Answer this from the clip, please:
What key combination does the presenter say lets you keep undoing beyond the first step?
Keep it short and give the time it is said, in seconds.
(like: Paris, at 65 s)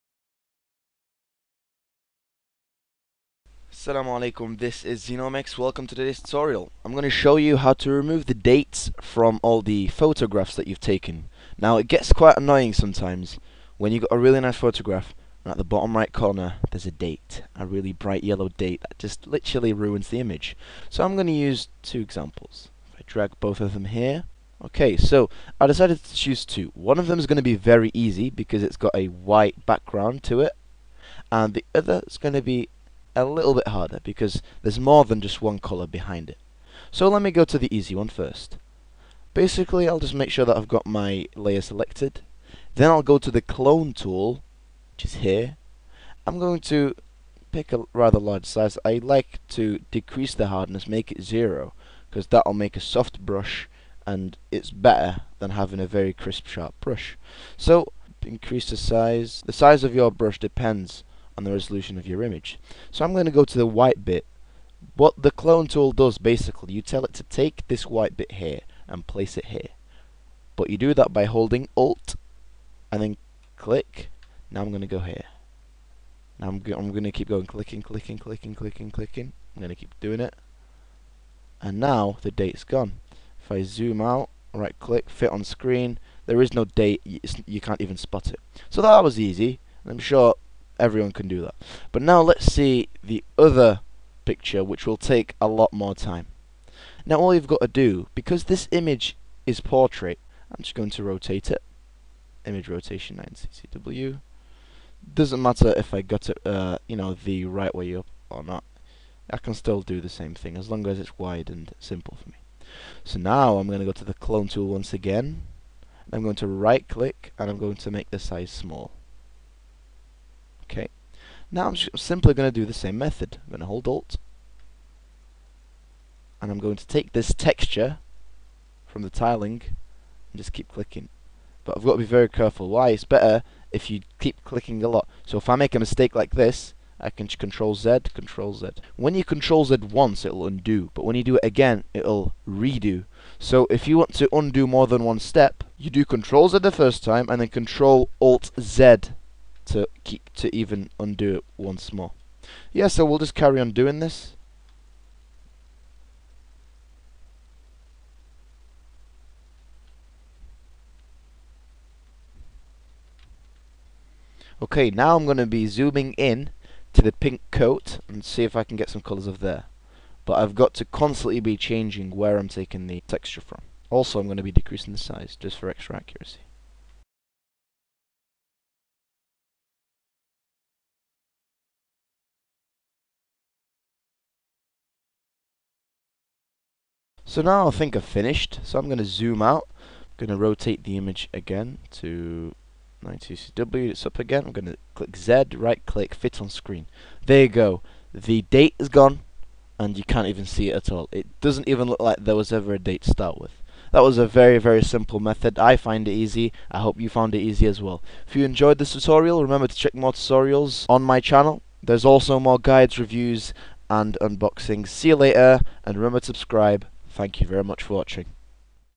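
Control Alt Z, at 147 s.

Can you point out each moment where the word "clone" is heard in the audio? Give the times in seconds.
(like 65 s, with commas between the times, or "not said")
43 s, 65 s, 114 s.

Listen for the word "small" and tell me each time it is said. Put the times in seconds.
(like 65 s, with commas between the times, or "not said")
118 s.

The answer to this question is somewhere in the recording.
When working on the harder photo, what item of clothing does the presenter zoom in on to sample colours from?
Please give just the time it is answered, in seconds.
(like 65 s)
167 s.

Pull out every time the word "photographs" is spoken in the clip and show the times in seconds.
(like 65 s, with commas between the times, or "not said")
9 s, 14 s.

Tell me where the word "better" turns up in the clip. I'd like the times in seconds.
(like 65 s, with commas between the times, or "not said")
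54 s, 133 s.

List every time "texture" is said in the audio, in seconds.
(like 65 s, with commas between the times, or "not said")
127 s, 173 s.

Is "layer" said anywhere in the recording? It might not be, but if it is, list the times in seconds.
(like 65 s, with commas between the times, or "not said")
41 s.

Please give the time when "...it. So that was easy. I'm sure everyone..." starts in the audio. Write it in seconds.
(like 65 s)
88 s.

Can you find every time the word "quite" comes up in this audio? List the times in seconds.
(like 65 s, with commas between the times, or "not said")
12 s.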